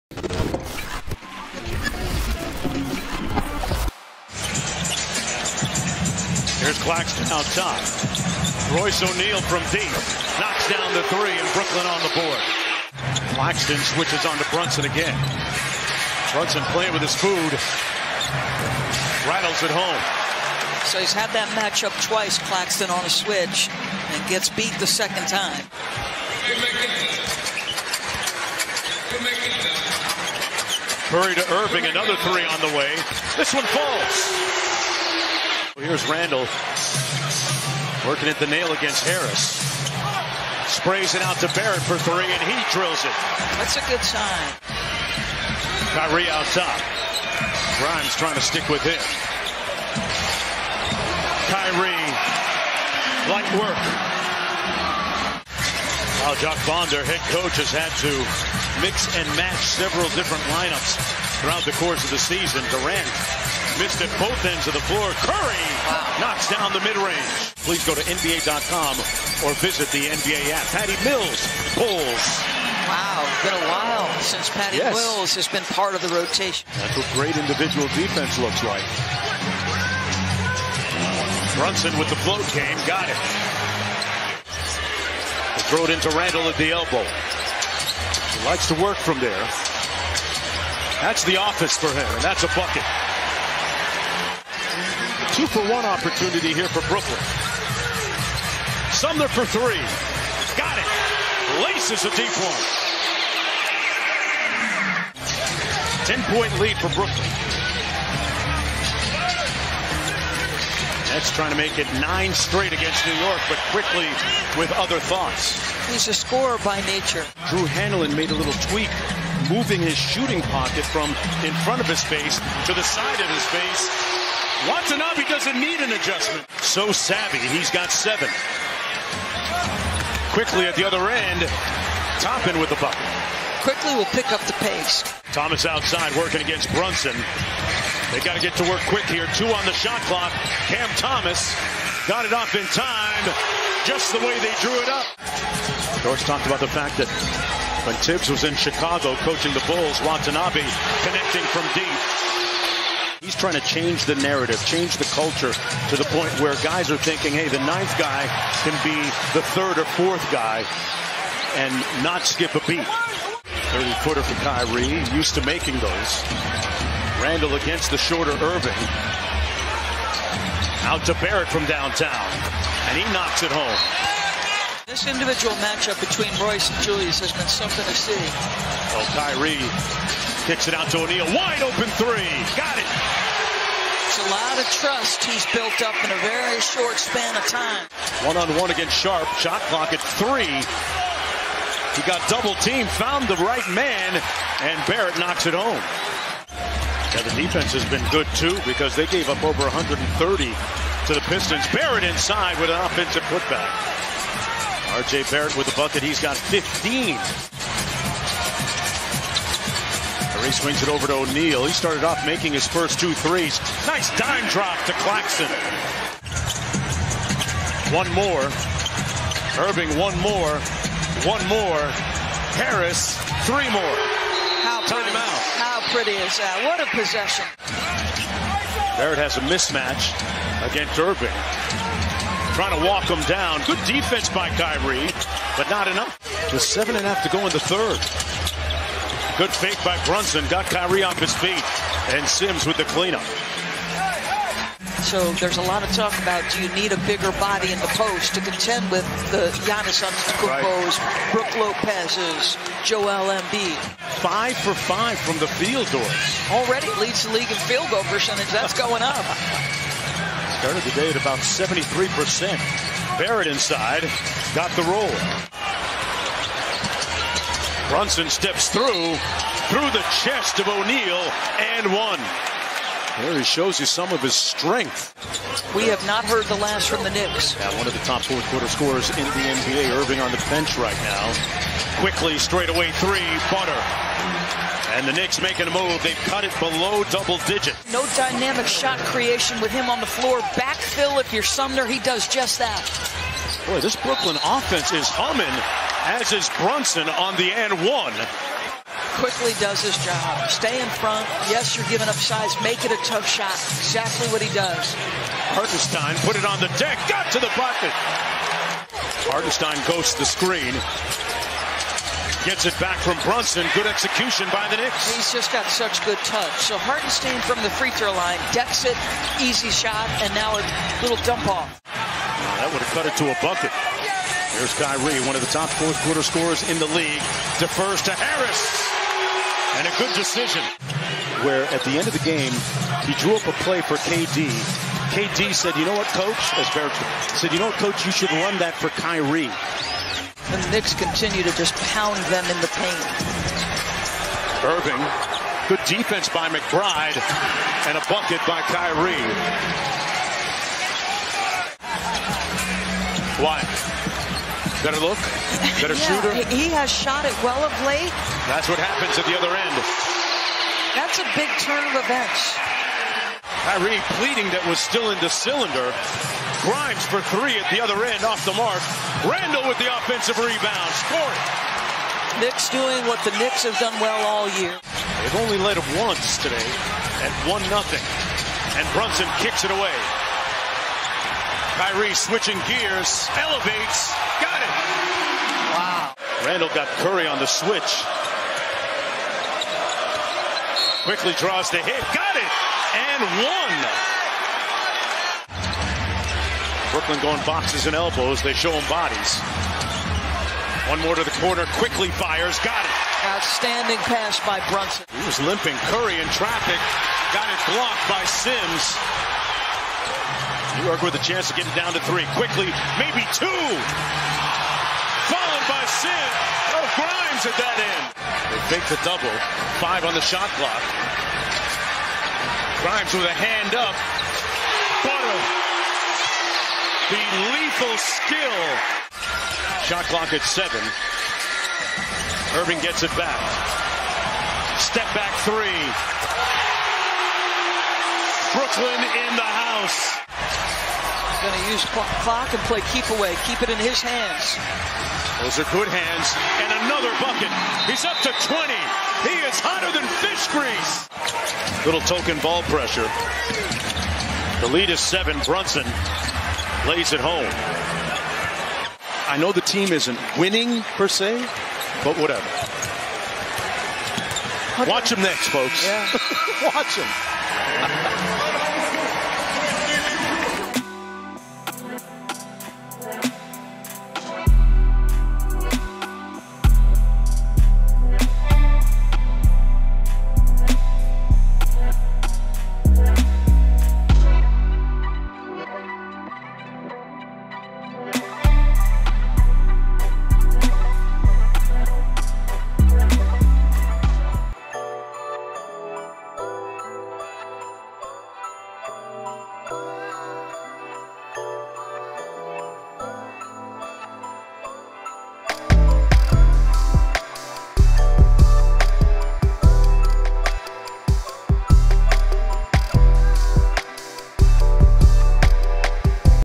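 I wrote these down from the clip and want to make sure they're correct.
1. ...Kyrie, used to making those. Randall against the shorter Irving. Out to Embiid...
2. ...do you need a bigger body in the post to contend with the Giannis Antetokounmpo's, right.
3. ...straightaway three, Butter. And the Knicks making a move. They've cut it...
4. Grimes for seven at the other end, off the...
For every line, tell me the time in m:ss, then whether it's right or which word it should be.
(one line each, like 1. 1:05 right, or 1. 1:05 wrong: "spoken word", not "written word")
1. 2:44 wrong: "Barrett", not "Embiid"
2. 4:06 right
3. 4:42 right
4. 6:06 wrong: "three", not "seven".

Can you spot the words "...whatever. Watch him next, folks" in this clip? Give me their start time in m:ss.
7:42.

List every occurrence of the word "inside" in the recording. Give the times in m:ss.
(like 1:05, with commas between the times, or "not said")
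3:22, 4:23.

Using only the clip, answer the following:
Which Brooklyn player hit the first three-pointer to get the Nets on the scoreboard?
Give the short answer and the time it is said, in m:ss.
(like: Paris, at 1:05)
Royce O'Neale, at 0:08.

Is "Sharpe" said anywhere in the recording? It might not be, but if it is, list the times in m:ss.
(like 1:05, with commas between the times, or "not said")
3:08.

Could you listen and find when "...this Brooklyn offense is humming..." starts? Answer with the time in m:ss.
4:53.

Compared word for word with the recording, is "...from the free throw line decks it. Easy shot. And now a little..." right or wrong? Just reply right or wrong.
right.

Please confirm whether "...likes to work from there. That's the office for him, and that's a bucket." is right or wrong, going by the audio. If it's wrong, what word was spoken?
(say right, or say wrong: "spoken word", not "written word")
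right.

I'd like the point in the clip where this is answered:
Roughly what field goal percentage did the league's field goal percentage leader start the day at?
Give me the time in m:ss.
4:21.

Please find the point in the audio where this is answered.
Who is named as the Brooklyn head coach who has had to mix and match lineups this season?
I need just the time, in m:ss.
0:56.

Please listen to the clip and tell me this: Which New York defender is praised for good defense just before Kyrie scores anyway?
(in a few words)
McBride.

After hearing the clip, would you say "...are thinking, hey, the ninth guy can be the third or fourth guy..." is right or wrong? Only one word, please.
right.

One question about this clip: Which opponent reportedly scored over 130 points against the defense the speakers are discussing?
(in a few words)
Pistons.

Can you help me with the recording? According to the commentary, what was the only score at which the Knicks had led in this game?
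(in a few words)
1-0.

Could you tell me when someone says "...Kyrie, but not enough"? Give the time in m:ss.
3:54.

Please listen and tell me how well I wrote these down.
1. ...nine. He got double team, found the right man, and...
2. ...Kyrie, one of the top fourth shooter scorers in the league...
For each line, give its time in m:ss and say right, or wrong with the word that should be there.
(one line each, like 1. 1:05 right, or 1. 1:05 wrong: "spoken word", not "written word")
1. 3:10 wrong: "three", not "nine"
2. 5:24 wrong: "quarter", not "shooter".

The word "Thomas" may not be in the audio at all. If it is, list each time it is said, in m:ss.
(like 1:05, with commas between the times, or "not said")
2:15, 2:20.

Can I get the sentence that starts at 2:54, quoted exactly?
This individual matchup between Royce and Julius has been something to see.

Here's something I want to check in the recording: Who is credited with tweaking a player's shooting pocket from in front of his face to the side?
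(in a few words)
Drew Hanlen.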